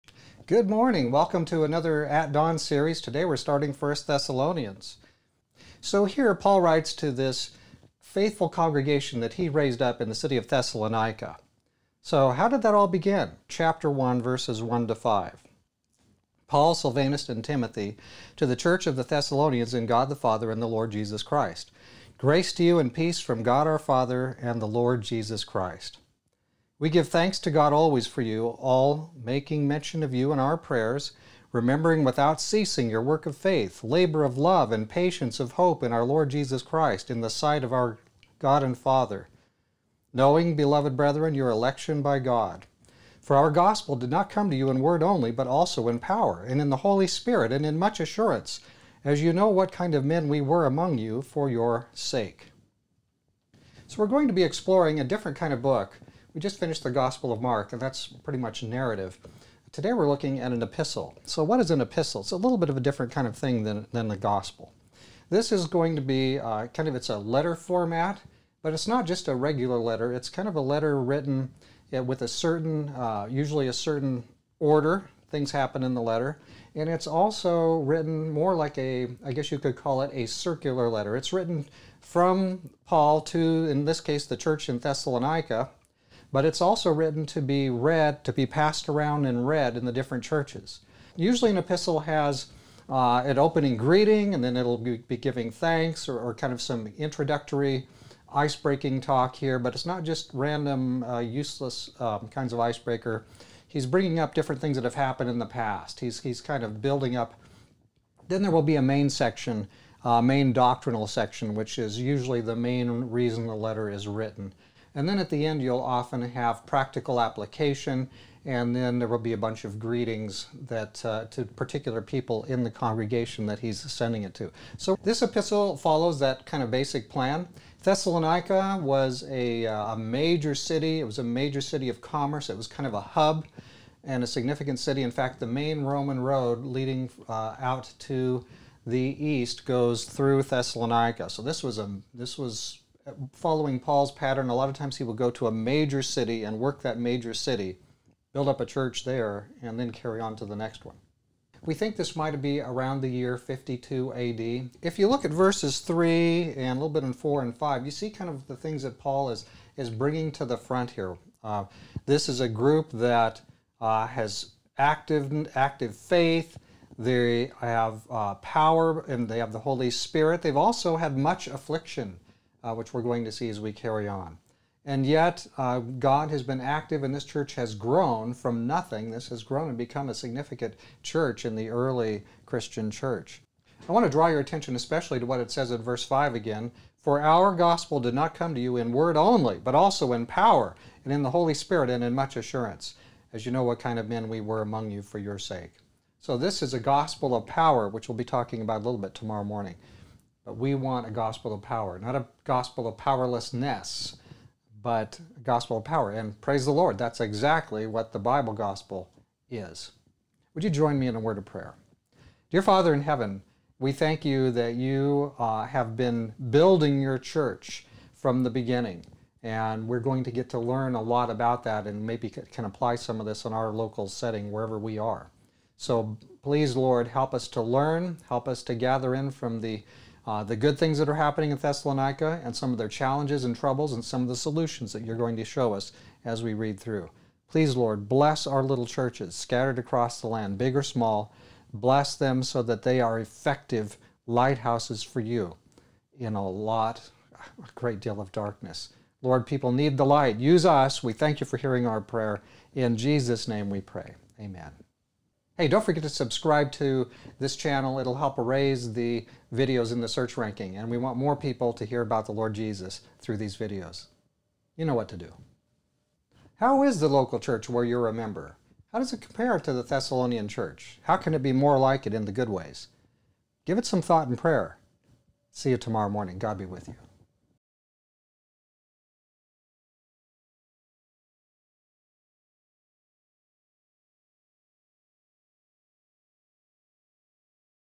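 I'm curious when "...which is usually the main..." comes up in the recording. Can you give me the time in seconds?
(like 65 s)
111 s.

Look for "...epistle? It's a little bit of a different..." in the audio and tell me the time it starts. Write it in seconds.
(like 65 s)
61 s.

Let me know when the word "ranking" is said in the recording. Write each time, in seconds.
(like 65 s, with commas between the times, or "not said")
260 s.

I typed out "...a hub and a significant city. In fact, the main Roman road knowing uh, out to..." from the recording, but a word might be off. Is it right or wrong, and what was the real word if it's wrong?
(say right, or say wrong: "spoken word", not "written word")
wrong: "leading", not "knowing".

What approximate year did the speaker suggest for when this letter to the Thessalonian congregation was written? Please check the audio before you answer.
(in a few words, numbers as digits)
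52 AD.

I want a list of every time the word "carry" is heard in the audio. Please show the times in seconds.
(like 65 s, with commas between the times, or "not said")
149 s, 173 s.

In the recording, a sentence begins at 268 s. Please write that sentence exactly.
How does it compare to the Thessalonian church?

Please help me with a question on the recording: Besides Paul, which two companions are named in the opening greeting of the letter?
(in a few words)
Silvanus and Timothy.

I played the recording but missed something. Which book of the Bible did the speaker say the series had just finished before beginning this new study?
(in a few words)
Gospel of Mark.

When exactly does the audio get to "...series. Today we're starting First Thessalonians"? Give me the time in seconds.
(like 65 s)
2 s.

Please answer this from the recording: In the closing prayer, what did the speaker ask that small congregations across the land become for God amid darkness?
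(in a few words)
Effective lighthouses.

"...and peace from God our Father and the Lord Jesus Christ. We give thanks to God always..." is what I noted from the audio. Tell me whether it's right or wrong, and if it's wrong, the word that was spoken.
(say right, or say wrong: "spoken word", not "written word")
right.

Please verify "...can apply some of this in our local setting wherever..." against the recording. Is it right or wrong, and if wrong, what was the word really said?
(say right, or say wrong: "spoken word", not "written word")
right.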